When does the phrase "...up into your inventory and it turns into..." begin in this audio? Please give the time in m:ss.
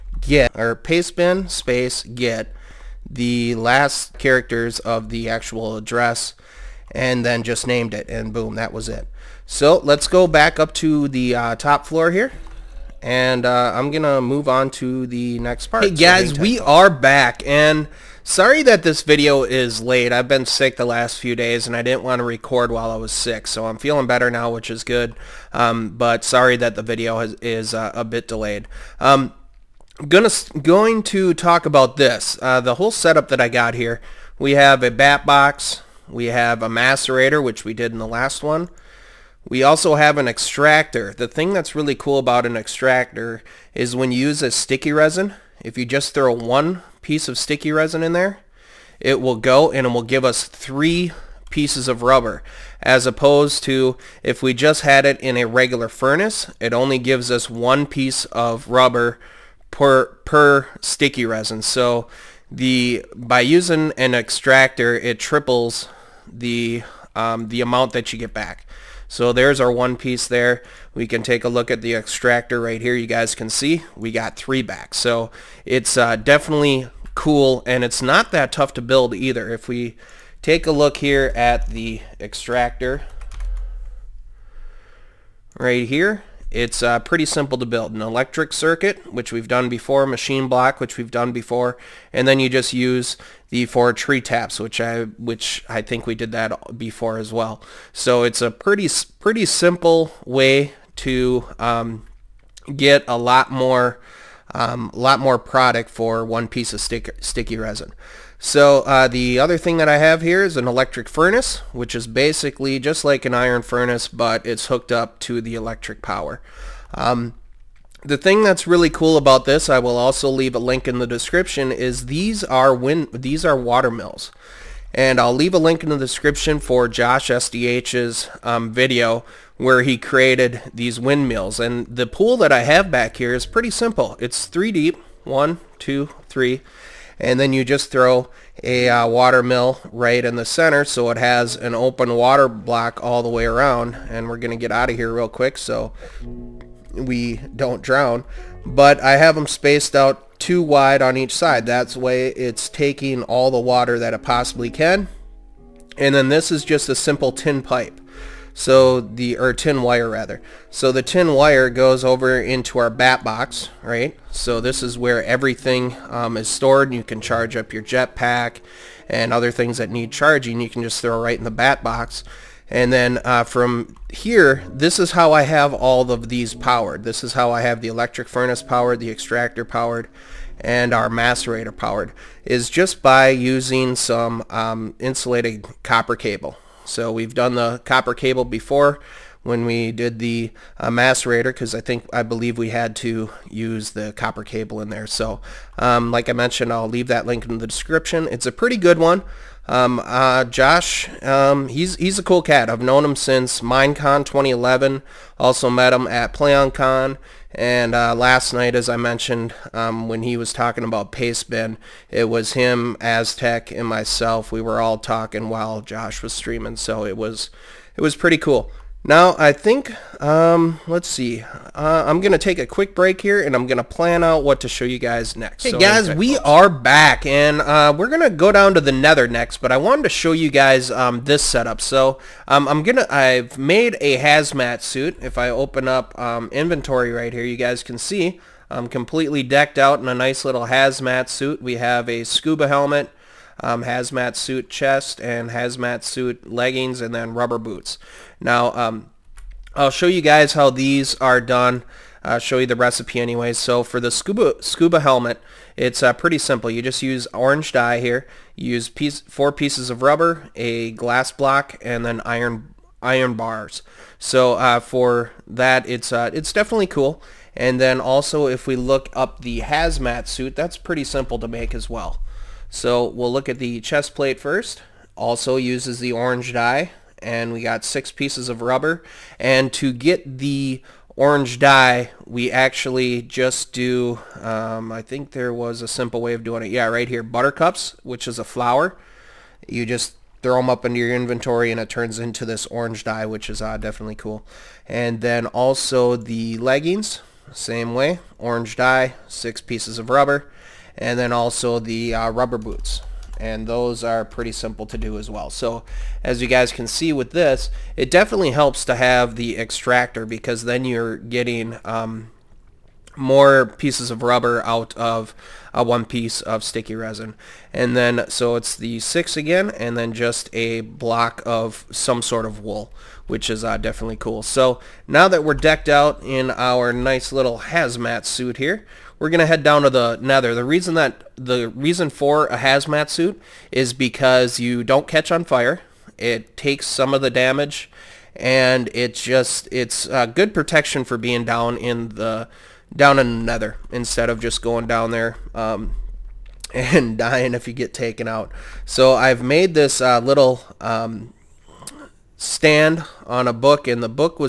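4:50.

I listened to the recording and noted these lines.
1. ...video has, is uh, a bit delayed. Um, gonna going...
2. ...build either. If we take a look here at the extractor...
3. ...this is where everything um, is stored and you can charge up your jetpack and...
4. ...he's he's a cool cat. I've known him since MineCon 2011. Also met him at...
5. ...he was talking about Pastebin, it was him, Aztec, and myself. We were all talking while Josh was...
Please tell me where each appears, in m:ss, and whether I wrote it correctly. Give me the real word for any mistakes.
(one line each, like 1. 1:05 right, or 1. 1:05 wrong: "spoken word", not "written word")
1. 0:26 right
2. 1:18 right
3. 2:44 right
4. 3:21 right
5. 3:30 right.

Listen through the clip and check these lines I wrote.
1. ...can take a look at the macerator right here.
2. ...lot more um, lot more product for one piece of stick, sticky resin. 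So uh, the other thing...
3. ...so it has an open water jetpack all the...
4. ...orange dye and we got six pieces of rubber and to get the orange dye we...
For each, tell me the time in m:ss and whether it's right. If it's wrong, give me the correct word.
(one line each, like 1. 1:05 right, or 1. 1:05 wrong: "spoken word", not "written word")
1. 1:11 wrong: "extractor", not "macerator"
2. 1:43 right
3. 2:20 wrong: "block", not "jetpack"
4. 4:36 right.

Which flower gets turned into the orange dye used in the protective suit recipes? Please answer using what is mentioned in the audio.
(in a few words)
Buttercups.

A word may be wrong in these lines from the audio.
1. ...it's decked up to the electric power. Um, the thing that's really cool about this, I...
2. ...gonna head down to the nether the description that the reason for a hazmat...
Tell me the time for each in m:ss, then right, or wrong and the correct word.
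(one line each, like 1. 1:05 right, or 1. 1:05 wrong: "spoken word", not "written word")
1. 1:54 wrong: "hooked", not "decked"
2. 5:29 wrong: "reason", not "description".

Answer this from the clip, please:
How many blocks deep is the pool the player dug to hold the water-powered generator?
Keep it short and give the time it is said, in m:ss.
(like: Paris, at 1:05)
3, at 2:14.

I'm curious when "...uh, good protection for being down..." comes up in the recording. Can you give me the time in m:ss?
5:40.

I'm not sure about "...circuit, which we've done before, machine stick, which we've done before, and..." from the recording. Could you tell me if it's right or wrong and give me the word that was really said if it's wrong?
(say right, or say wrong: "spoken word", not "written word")
wrong: "block", not "stick".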